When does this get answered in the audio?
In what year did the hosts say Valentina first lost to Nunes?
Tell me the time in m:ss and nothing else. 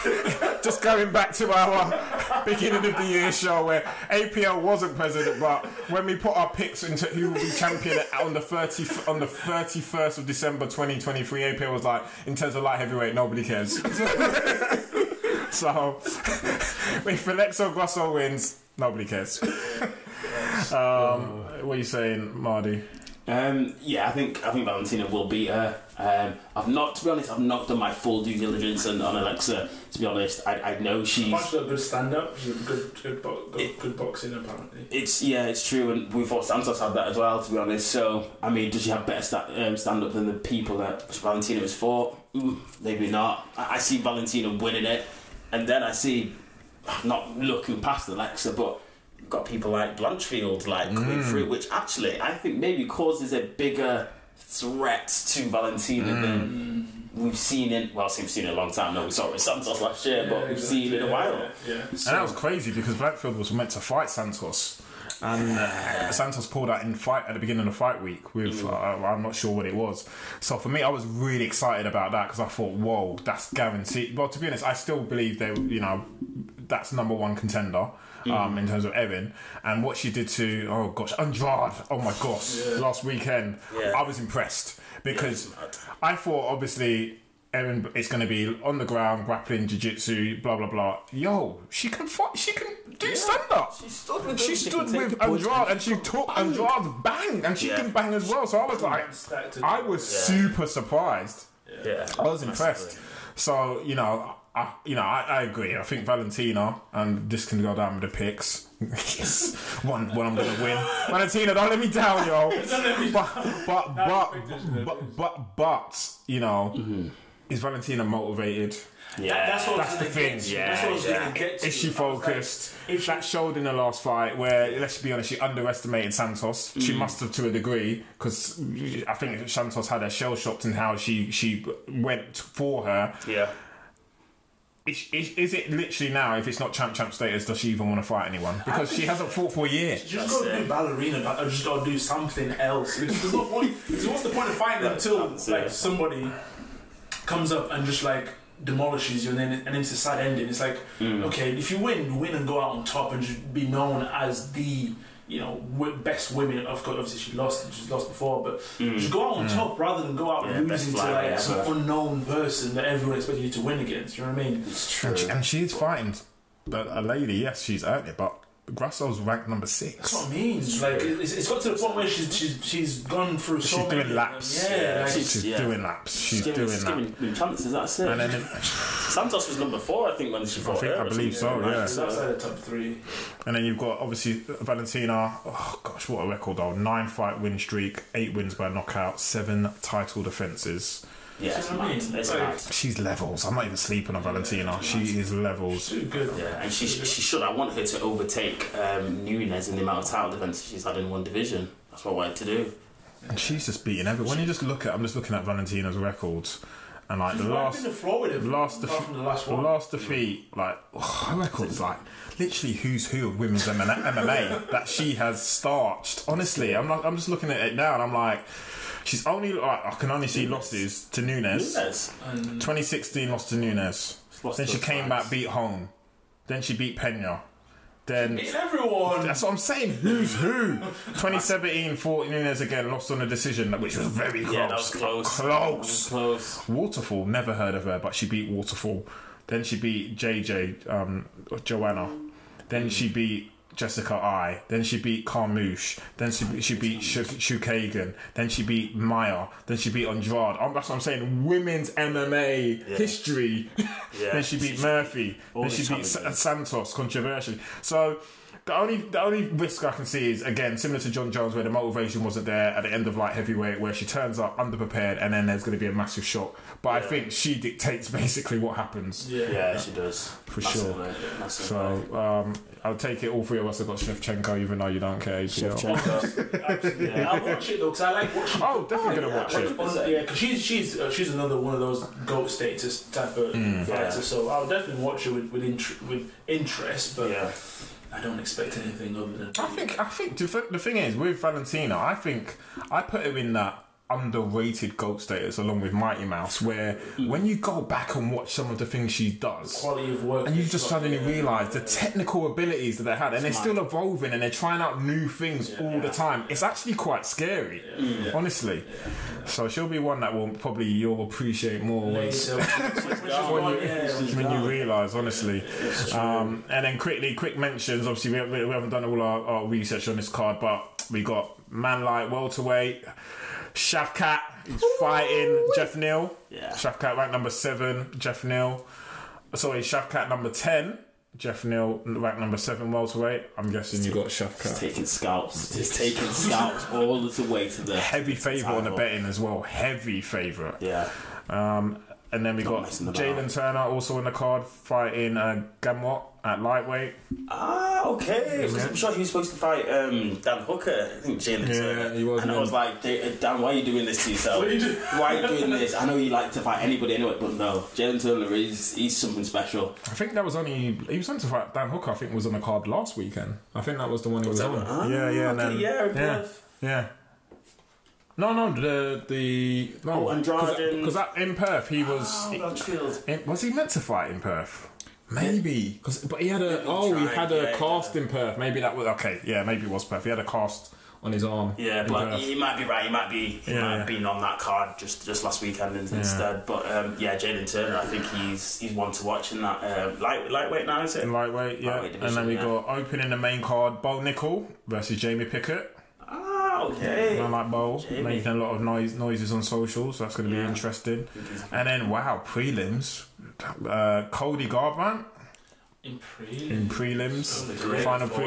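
3:42.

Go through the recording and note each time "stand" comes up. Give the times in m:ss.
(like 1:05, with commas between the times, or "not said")
0:31, 0:39, 1:33.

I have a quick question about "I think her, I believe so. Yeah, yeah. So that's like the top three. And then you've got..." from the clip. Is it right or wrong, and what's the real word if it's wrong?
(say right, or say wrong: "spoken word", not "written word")
right.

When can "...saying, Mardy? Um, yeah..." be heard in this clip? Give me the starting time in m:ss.
0:21.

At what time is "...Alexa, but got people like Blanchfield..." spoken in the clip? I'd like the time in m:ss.
0:48.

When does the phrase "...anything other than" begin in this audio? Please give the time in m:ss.
4:48.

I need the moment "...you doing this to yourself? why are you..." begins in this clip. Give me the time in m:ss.
5:53.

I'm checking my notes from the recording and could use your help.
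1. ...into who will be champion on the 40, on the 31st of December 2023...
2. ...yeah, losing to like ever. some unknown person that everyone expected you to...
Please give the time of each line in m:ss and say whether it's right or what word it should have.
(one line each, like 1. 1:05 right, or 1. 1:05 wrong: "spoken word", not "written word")
1. 0:06 wrong: "30", not "40"
2. 2:40 right.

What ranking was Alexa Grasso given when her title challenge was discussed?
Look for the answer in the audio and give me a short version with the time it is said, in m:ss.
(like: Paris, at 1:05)
number six, at 2:49.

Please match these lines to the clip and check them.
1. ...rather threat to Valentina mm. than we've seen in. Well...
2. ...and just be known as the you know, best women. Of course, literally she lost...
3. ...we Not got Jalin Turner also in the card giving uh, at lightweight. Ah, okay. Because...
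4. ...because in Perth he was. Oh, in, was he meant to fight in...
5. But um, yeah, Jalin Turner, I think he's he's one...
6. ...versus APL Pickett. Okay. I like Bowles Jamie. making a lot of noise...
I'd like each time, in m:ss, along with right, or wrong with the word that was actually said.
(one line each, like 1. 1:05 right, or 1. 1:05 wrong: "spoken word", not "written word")
1. 0:53 wrong: "bigger", not "rather"
2. 2:33 wrong: "obviously", not "literally"
3. 5:42 wrong: "fighting", not "giving"
4. 6:10 right
5. 6:26 right
6. 6:34 wrong: "Jamie", not "APL".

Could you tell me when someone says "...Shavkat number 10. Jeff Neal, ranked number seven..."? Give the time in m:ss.
5:29.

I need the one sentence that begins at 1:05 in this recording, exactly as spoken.
And uh, Santos pulled out in fight at the beginning of fight week with mm.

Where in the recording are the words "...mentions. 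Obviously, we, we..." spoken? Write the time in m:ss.
5:17.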